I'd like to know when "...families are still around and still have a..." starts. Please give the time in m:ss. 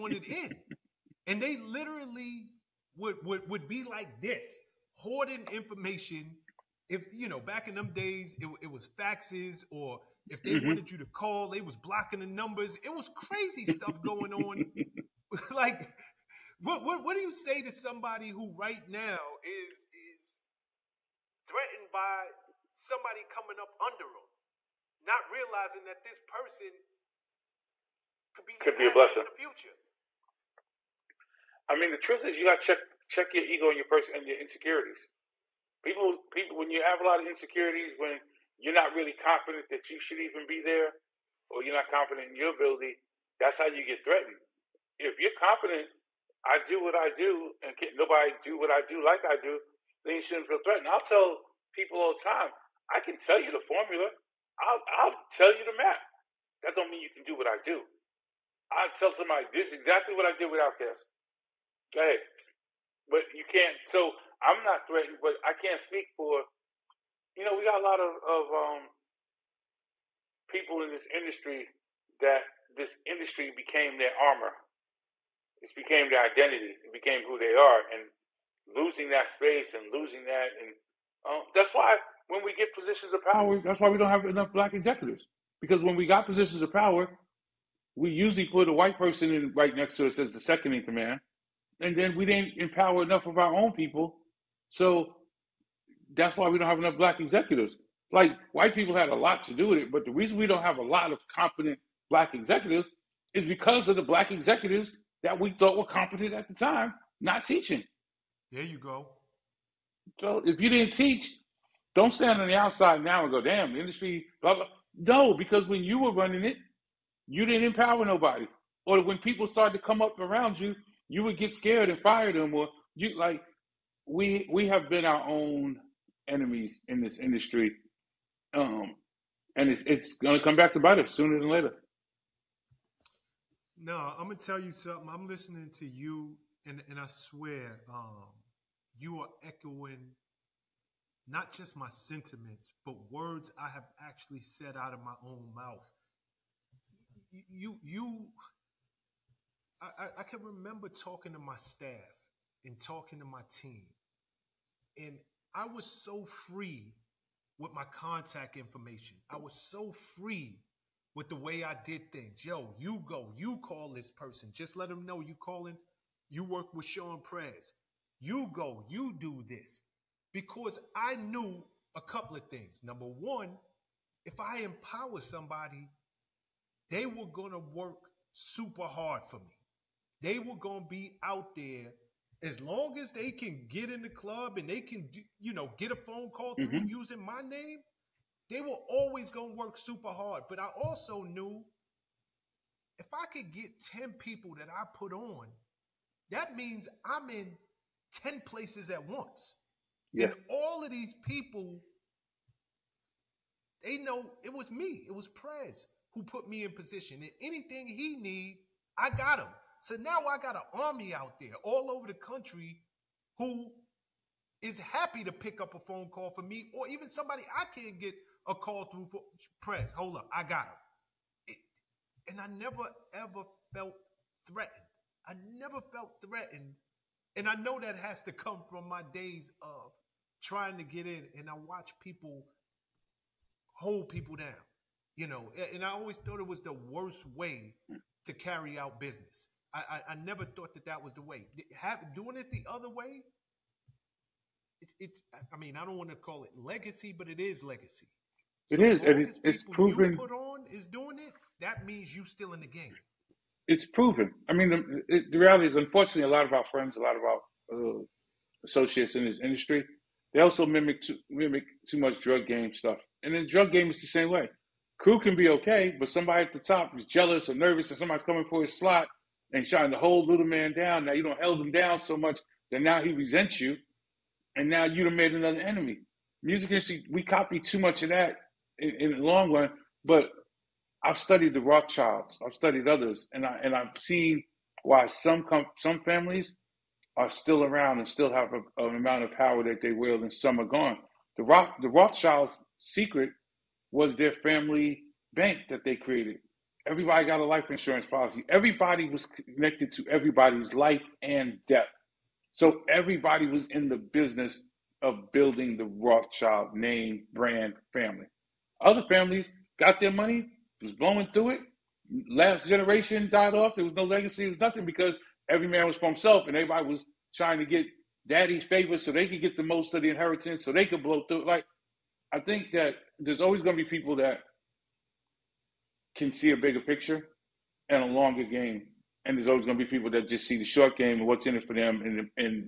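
4:46.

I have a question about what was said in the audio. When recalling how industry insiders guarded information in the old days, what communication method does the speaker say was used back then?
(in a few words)
faxes.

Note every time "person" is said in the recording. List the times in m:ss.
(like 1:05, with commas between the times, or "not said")
0:26, 0:33, 1:28, 2:44.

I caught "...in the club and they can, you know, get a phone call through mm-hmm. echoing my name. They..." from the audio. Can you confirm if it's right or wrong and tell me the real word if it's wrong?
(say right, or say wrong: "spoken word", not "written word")
wrong: "using", not "echoing".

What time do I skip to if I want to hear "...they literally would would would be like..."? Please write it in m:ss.
0:01.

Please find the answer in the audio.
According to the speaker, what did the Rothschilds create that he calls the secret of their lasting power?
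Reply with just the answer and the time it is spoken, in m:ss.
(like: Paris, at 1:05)
family bank, at 4:54.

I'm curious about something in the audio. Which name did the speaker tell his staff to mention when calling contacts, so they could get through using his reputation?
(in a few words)
Shawn Prez.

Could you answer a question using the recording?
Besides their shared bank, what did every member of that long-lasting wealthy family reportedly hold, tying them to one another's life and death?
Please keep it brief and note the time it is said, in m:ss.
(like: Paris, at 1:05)
life insurance policy, at 4:57.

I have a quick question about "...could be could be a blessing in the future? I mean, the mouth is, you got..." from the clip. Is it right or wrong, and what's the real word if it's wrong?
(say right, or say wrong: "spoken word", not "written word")
wrong: "truth", not "mouth".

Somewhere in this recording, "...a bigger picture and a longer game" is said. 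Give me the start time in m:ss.
5:26.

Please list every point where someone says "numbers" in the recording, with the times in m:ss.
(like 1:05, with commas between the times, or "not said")
0:12, 2:52.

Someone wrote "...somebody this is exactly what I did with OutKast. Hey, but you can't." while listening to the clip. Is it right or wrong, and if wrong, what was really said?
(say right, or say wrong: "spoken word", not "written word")
right.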